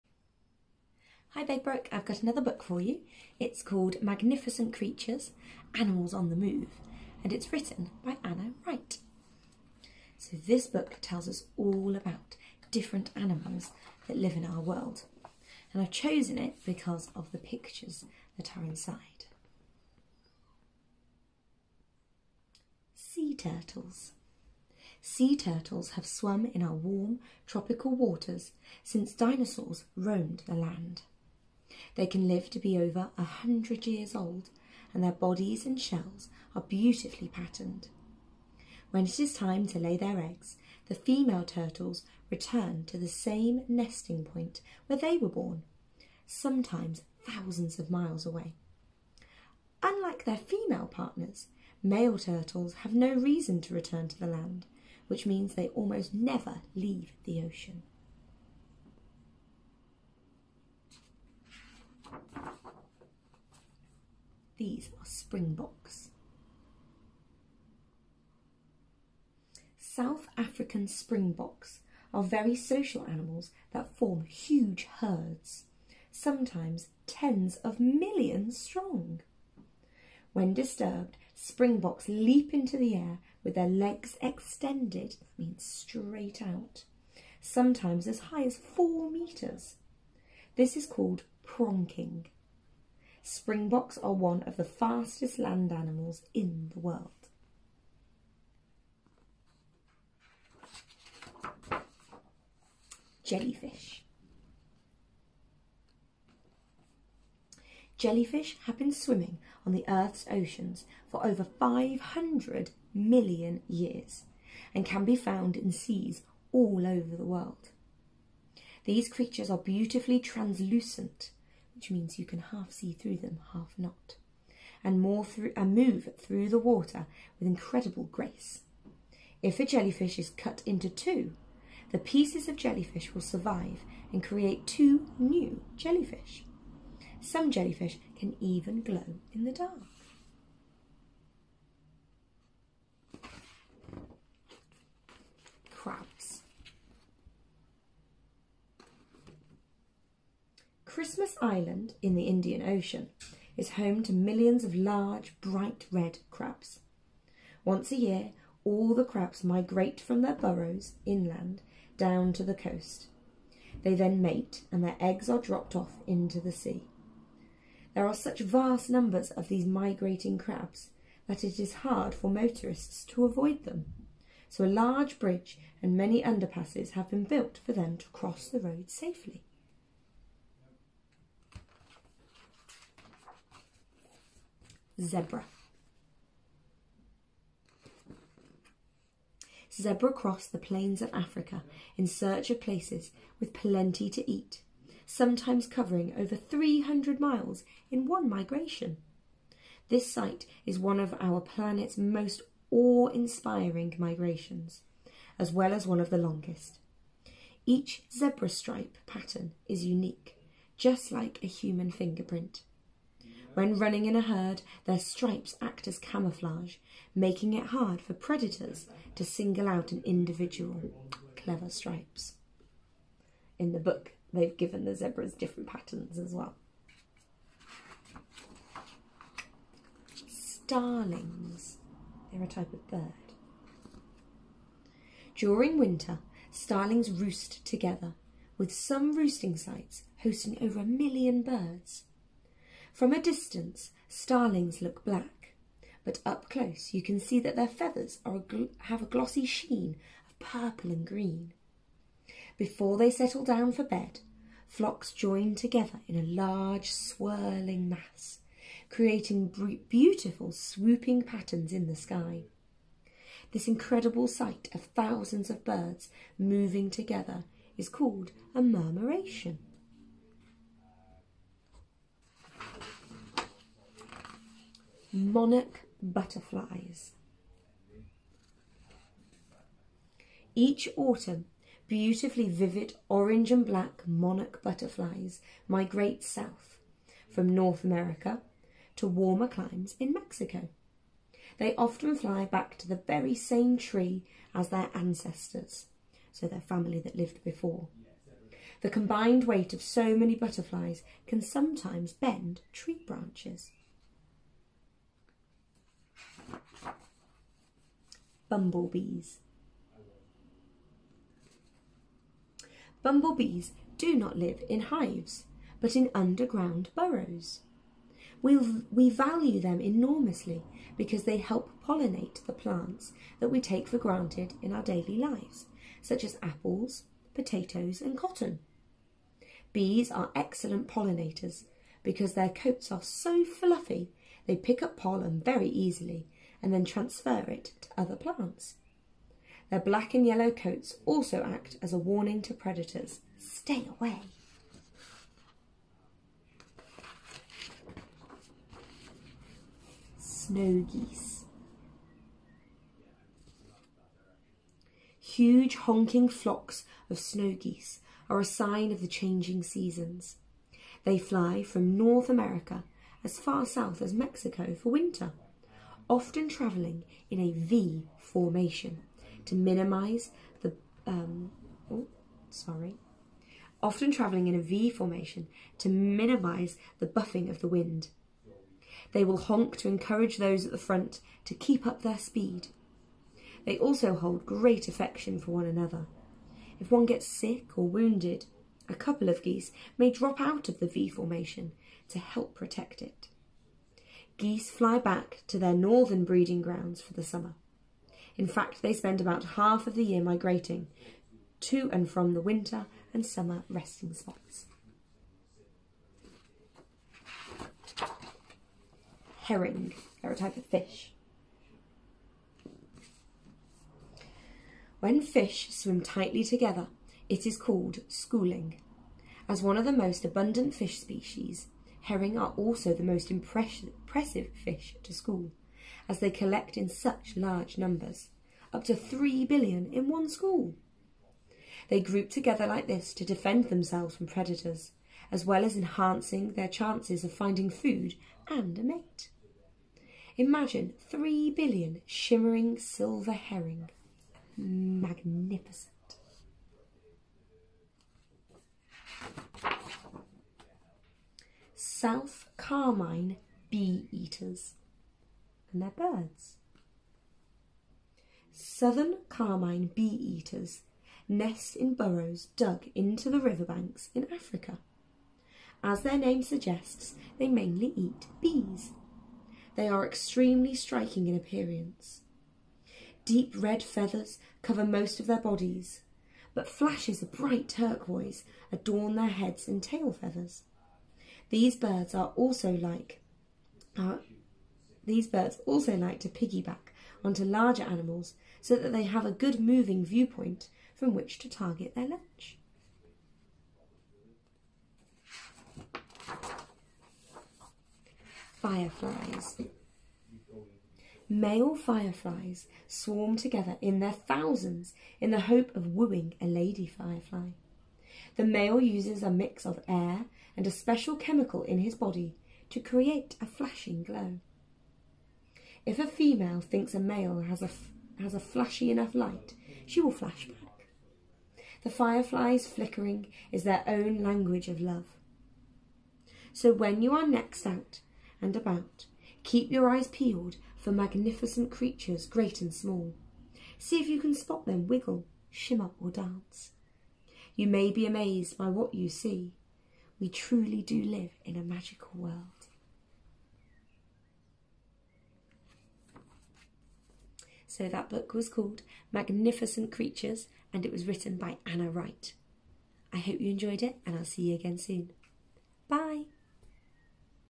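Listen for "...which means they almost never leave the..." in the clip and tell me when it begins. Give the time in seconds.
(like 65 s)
55 s.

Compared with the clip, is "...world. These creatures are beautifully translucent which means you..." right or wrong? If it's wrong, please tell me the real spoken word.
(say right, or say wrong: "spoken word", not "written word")
right.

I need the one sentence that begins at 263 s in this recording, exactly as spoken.
This incredible sight of thousands of birds moving together is called a murmuration.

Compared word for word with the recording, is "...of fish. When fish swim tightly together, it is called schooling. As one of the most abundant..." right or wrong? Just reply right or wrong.
right.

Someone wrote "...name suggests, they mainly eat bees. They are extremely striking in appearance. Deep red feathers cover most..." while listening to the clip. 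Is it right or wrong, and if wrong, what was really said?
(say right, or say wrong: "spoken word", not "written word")
right.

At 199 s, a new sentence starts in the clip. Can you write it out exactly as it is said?
This site is one of our planet's most awe-inspiring migrations, as well as one of the longest.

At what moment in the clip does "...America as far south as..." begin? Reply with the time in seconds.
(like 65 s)
362 s.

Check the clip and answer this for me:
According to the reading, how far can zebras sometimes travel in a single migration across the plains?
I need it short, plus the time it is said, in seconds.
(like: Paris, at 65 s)
over 300 miles, at 196 s.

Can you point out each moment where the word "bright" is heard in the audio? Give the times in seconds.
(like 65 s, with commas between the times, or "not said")
155 s, 477 s.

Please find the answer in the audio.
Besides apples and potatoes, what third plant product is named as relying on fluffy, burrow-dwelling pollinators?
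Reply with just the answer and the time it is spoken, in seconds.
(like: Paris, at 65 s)
cotton, at 328 s.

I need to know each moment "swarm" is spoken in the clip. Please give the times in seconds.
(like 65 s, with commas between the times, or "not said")
502 s.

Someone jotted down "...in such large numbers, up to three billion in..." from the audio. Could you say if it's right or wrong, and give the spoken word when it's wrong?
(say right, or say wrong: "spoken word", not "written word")
right.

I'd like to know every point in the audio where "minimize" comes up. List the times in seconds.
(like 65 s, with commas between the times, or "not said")
369 s, 375 s.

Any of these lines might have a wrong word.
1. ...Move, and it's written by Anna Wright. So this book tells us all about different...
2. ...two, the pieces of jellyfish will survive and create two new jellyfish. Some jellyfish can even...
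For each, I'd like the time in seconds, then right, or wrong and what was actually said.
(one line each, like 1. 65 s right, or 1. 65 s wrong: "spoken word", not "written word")
1. 6 s right
2. 130 s right.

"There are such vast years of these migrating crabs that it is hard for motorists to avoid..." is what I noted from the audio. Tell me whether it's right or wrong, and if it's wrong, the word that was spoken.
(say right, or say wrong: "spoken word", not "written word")
wrong: "numbers", not "years".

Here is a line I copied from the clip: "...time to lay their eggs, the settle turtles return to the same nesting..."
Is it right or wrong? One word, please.
wrong.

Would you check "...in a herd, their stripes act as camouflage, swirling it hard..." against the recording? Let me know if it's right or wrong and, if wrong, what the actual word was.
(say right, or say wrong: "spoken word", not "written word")
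wrong: "making", not "swirling".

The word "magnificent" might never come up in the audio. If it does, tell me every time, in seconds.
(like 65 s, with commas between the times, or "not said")
4 s, 444 s, 530 s, 549 s.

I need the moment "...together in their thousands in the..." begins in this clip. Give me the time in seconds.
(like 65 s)
503 s.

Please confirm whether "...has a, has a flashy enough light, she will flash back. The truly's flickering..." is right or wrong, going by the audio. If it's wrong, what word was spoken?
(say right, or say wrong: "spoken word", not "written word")
wrong: "firefly", not "truly".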